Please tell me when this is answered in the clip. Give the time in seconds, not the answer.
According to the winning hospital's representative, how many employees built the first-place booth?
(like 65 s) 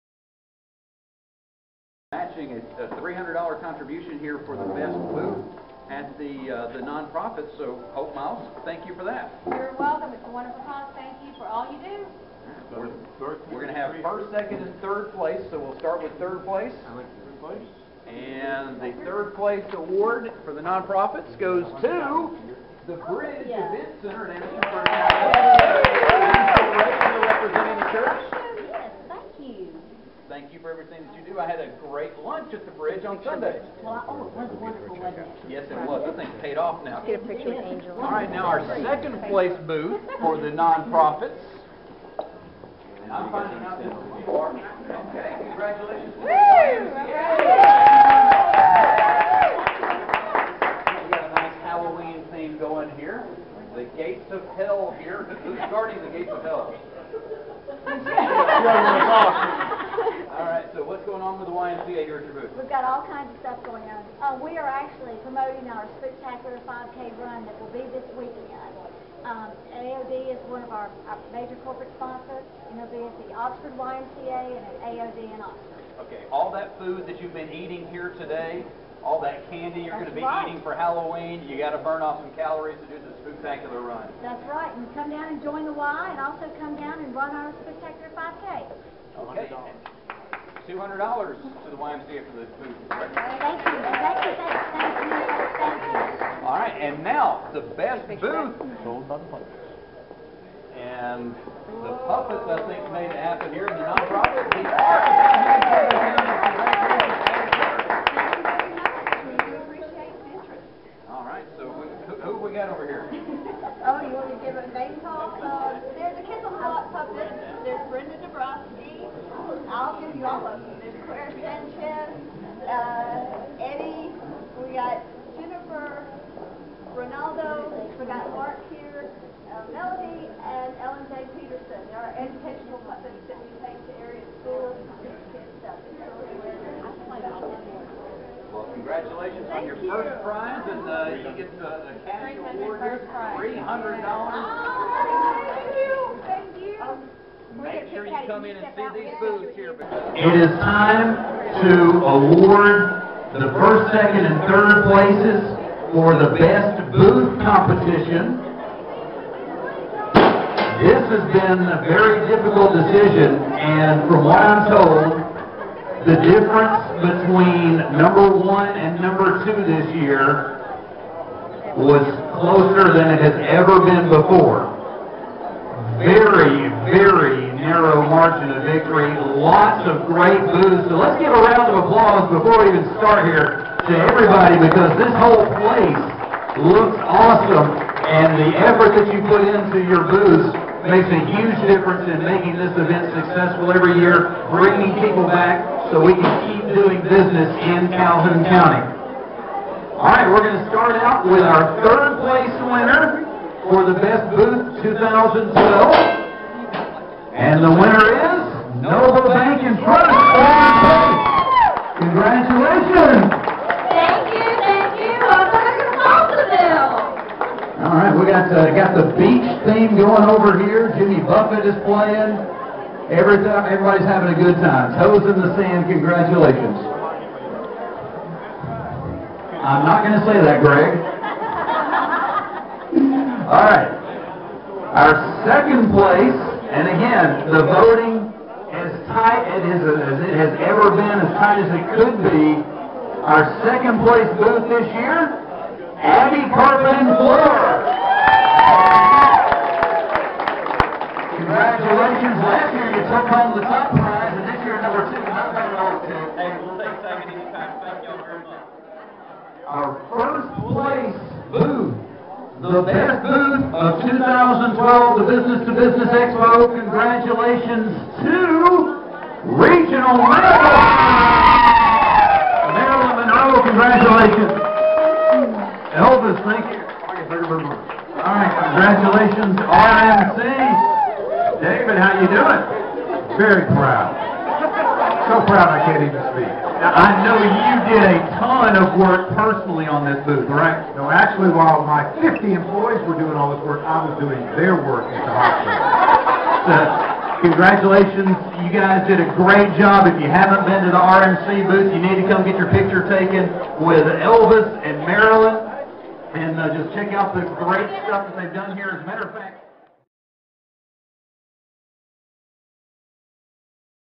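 292 s.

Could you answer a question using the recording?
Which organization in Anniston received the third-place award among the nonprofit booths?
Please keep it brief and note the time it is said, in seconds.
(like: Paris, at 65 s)
Bridge Event Center, at 22 s.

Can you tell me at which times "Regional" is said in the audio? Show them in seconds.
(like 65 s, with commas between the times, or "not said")
269 s.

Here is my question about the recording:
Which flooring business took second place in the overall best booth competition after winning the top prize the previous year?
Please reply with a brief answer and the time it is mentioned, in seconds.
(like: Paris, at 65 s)
Abbey Carpet and Floor, at 246 s.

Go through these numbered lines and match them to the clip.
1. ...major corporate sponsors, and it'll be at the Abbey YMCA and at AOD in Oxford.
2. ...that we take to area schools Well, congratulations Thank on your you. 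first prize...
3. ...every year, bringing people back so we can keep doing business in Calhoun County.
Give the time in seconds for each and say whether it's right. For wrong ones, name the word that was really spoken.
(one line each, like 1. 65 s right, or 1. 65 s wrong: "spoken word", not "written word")
1. 71 s wrong: "Oxford", not "Abbey"
2. 133 s right
3. 193 s right.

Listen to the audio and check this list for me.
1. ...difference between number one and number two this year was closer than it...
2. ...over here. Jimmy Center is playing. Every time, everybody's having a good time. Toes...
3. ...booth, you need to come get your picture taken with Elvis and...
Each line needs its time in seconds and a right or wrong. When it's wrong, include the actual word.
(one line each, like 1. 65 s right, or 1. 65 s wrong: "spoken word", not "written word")
1. 166 s right
2. 220 s wrong: "Buffett", not "Center"
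3. 301 s right.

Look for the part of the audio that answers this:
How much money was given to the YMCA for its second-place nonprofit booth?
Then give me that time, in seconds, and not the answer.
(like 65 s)
90 s.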